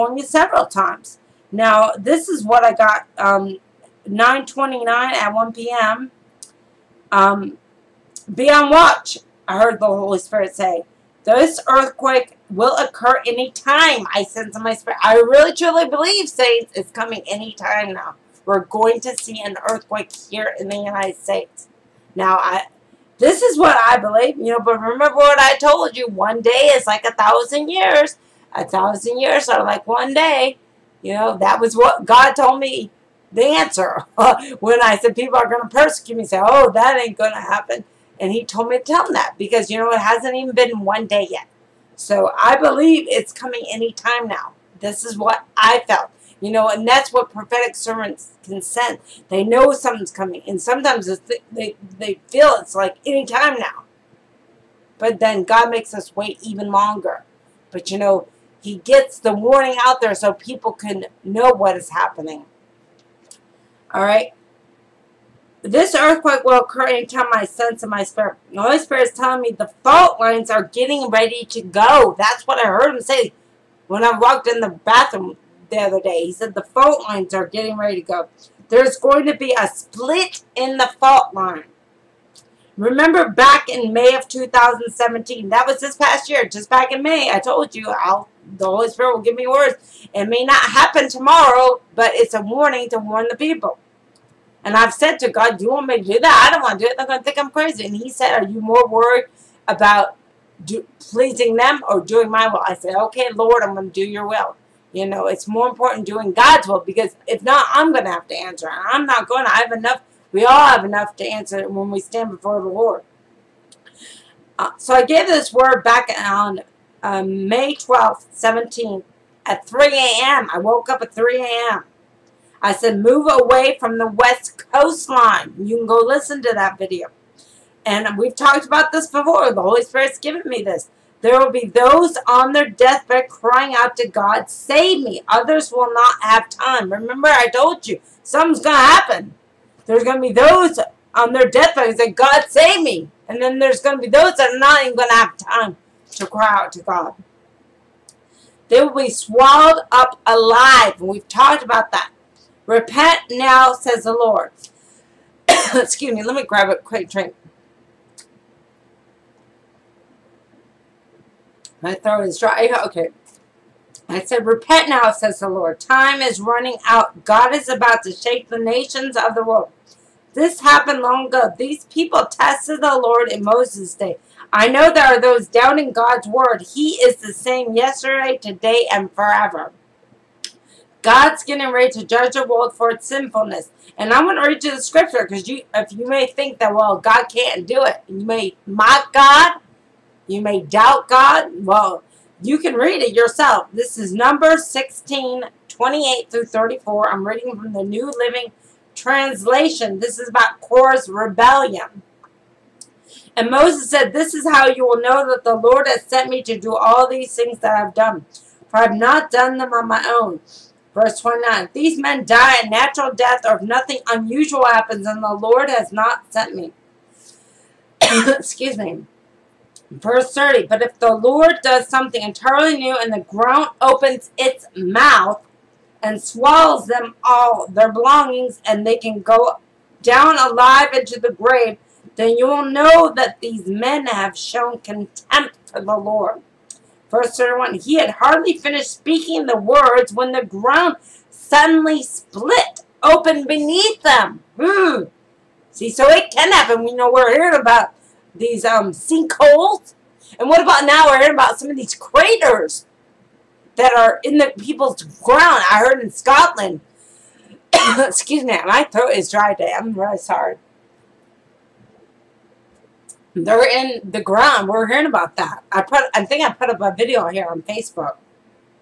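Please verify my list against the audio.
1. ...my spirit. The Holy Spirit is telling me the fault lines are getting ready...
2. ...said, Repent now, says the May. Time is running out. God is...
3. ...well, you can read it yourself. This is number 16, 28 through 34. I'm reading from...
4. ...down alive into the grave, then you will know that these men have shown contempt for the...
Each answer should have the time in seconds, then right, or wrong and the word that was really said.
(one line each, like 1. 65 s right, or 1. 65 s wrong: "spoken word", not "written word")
1. 67 s right
2. 164 s wrong: "Lord", not "May"
3. 191 s right
4. 230 s right.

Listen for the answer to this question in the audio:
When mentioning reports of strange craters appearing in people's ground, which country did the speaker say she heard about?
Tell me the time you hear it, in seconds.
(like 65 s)
256 s.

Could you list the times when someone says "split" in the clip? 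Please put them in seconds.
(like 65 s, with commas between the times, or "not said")
79 s, 242 s.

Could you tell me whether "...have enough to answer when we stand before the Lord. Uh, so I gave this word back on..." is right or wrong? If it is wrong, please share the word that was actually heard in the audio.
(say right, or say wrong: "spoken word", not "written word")
right.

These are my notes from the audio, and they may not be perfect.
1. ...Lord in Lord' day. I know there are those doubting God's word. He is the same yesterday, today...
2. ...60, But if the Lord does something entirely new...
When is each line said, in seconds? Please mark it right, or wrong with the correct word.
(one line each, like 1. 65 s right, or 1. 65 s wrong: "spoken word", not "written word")
1. 173 s wrong: "Moses", not "Lord"
2. 220 s wrong: "30", not "60".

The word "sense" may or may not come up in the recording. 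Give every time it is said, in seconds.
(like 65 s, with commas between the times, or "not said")
14 s, 48 s, 67 s.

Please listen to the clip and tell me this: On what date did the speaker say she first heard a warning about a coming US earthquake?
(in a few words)
9.29.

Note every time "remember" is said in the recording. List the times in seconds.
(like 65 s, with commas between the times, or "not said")
24 s, 82 s, 136 s.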